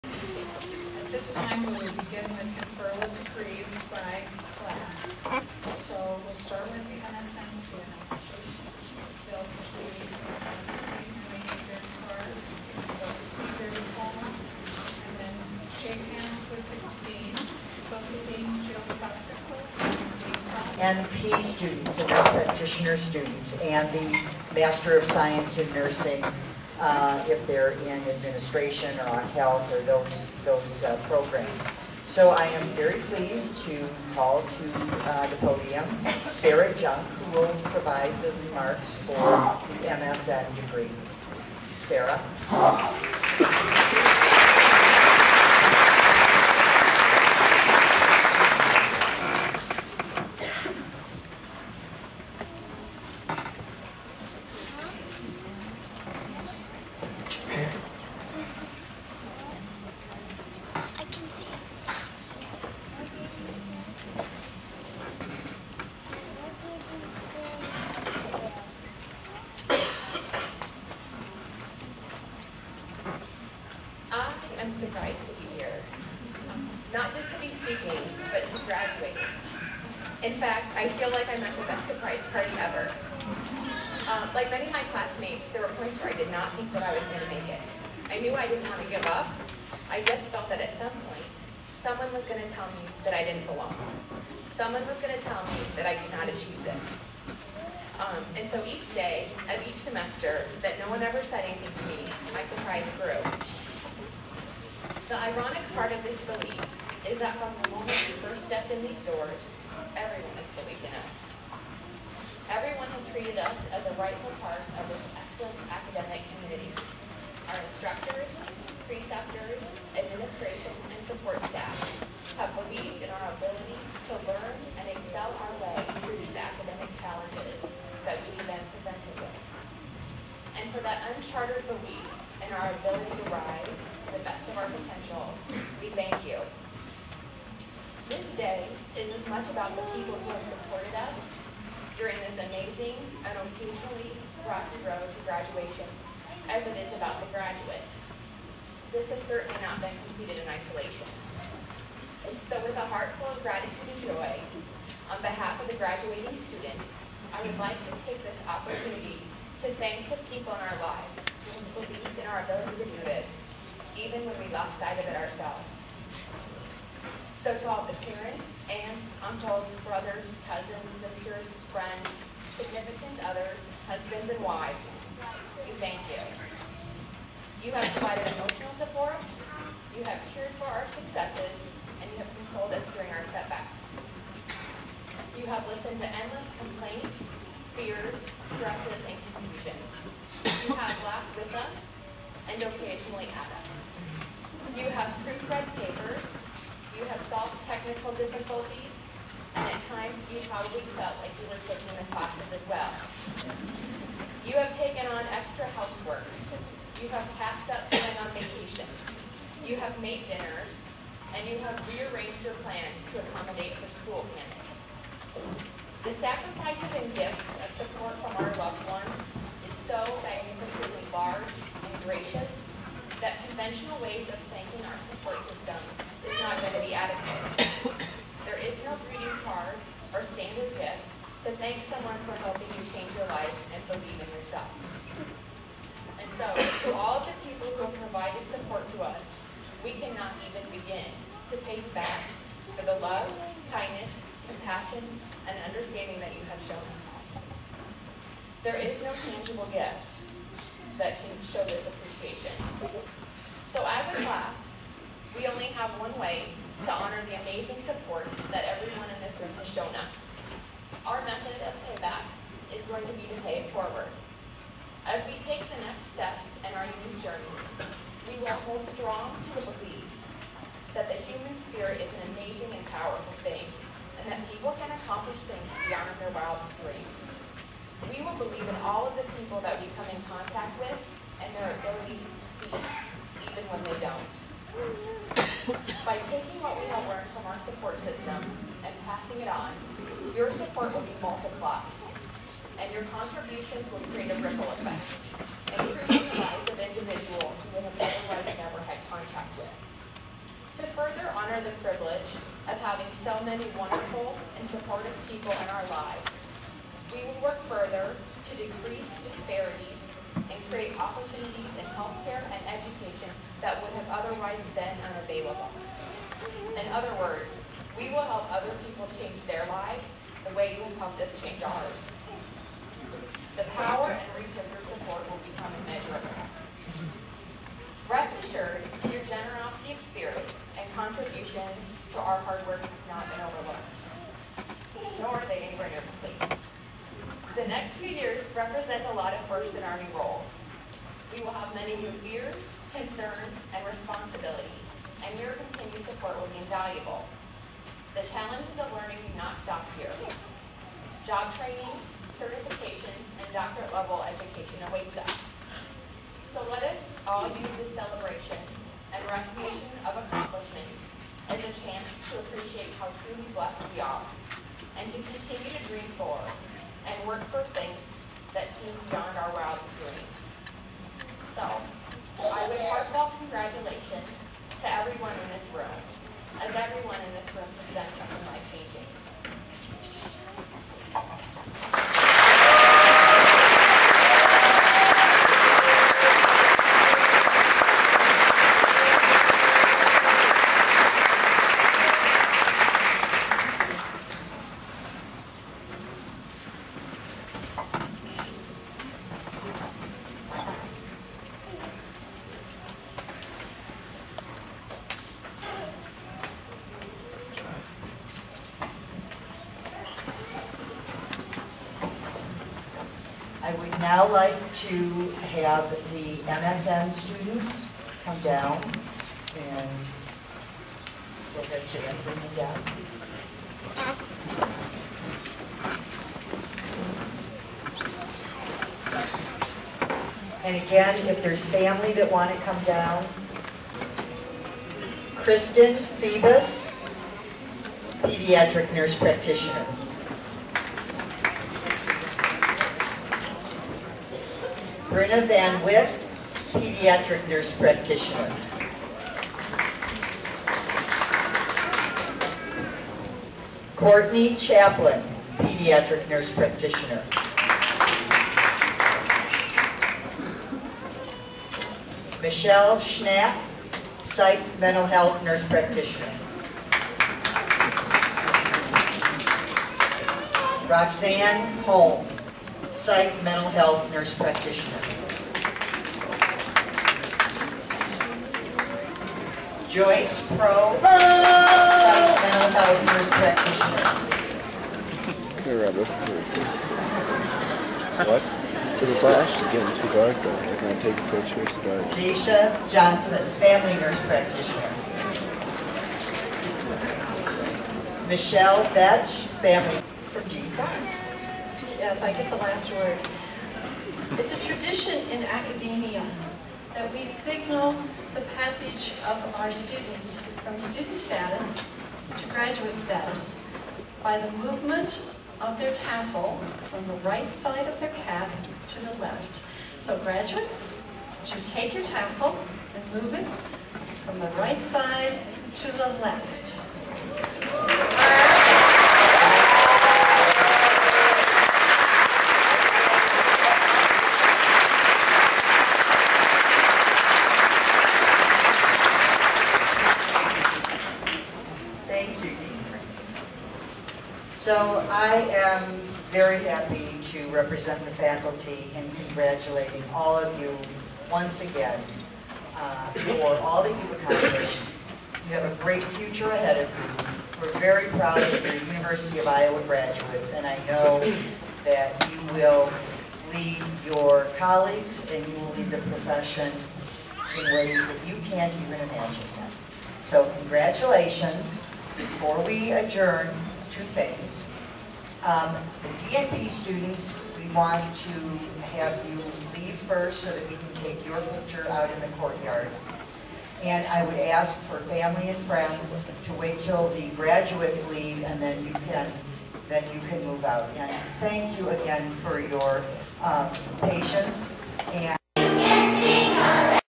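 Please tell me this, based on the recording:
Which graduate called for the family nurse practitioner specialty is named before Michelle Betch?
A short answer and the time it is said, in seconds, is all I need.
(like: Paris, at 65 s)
Deisha Johnson, at 492 s.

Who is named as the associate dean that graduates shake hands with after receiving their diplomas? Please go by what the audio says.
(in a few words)
Jill Scott.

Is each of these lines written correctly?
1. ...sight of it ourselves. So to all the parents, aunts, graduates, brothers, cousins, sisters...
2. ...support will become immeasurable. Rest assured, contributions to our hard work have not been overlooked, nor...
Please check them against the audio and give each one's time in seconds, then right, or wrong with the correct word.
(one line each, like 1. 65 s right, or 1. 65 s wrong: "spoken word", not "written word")
1. 164 s wrong: "uncles", not "graduates"
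2. 324 s right.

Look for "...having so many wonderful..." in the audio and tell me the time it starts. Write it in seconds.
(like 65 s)
302 s.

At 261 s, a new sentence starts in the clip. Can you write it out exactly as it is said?
Our method of payback is going to be to pay it forward.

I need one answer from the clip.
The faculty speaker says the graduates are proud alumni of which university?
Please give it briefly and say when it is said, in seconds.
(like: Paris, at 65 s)
University of Iowa, at 558 s.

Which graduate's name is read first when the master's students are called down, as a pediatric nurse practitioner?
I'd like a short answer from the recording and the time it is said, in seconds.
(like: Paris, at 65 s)
Kristen Phoebus, at 435 s.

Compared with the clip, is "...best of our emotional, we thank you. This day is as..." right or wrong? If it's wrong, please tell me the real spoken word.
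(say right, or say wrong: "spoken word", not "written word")
wrong: "potential", not "emotional".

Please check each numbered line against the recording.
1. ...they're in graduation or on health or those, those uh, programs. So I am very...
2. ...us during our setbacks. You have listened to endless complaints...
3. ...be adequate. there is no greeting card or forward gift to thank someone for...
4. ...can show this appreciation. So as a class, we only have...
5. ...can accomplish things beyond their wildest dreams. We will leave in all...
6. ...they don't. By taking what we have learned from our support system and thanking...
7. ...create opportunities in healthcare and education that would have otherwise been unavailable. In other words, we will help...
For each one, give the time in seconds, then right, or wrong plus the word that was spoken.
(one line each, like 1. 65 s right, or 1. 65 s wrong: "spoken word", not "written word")
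1. 27 s wrong: "administration", not "graduation"
2. 182 s right
3. 226 s wrong: "standard", not "forward"
4. 251 s right
5. 274 s wrong: "believe", not "leave"
6. 283 s wrong: "passing", not "thanking"
7. 310 s right.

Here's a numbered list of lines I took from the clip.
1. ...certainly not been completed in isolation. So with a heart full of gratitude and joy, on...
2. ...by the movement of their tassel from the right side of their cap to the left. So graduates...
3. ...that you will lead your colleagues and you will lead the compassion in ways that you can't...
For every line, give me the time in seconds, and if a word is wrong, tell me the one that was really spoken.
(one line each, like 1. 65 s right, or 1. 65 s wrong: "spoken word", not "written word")
1. 149 s right
2. 514 s right
3. 561 s wrong: "profession", not "compassion".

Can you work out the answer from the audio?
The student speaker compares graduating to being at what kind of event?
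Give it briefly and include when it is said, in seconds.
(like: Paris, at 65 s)
surprise party, at 81 s.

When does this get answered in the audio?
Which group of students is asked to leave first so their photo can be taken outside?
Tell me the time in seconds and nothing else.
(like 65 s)
576 s.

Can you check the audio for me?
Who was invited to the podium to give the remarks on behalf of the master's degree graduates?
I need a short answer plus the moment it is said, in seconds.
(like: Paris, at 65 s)
Sarah Junk, at 36 s.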